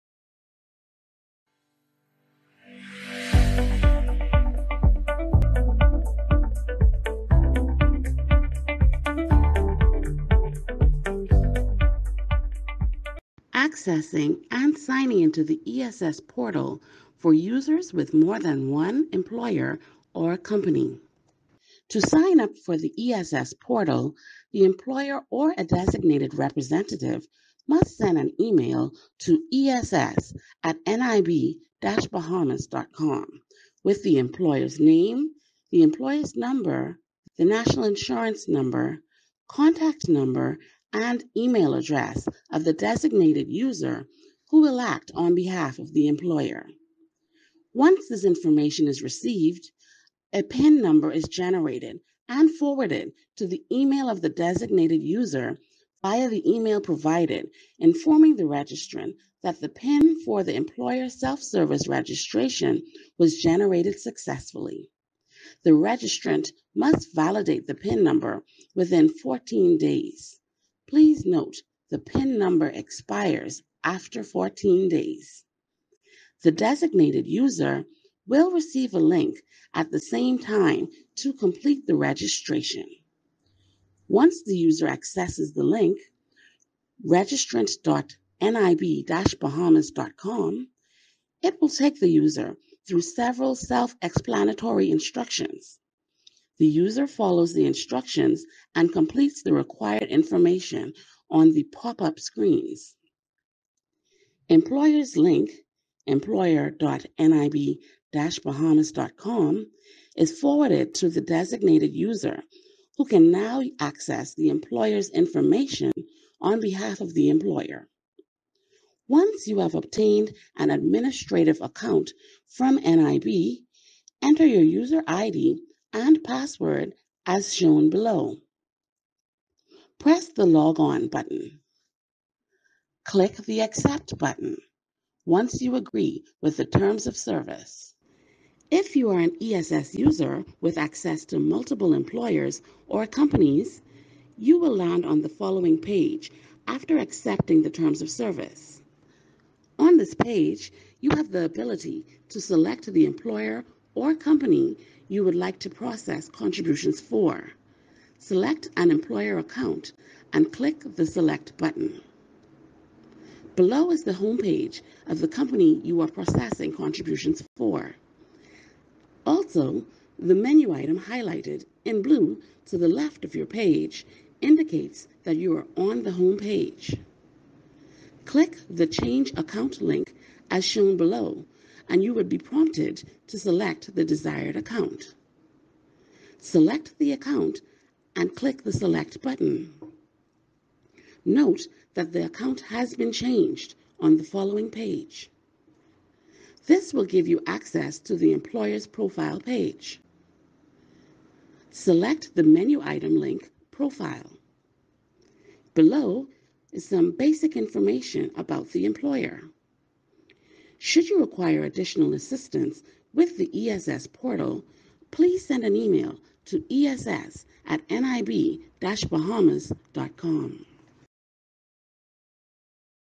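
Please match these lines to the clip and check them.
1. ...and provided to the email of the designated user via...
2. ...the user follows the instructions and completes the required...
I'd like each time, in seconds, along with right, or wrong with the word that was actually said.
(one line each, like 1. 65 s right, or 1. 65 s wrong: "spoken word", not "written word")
1. 52 s wrong: "forwarded", not "provided"
2. 96 s right.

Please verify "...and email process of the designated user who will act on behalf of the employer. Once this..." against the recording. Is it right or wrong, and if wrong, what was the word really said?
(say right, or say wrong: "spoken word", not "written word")
wrong: "address", not "process".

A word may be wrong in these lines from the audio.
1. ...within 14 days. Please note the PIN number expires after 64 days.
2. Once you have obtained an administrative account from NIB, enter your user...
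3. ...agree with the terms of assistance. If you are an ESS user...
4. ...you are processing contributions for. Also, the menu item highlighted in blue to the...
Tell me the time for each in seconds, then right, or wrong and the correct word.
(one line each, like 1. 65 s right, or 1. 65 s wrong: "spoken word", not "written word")
1. 68 s wrong: "14", not "64"
2. 119 s right
3. 135 s wrong: "service", not "assistance"
4. 165 s right.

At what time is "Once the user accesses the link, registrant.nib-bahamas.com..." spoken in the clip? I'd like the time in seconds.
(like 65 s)
84 s.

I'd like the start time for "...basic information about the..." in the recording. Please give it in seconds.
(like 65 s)
207 s.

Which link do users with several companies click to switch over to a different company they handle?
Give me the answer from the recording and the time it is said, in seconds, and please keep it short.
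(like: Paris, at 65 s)
Change Account, at 178 s.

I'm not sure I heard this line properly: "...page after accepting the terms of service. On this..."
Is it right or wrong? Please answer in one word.
right.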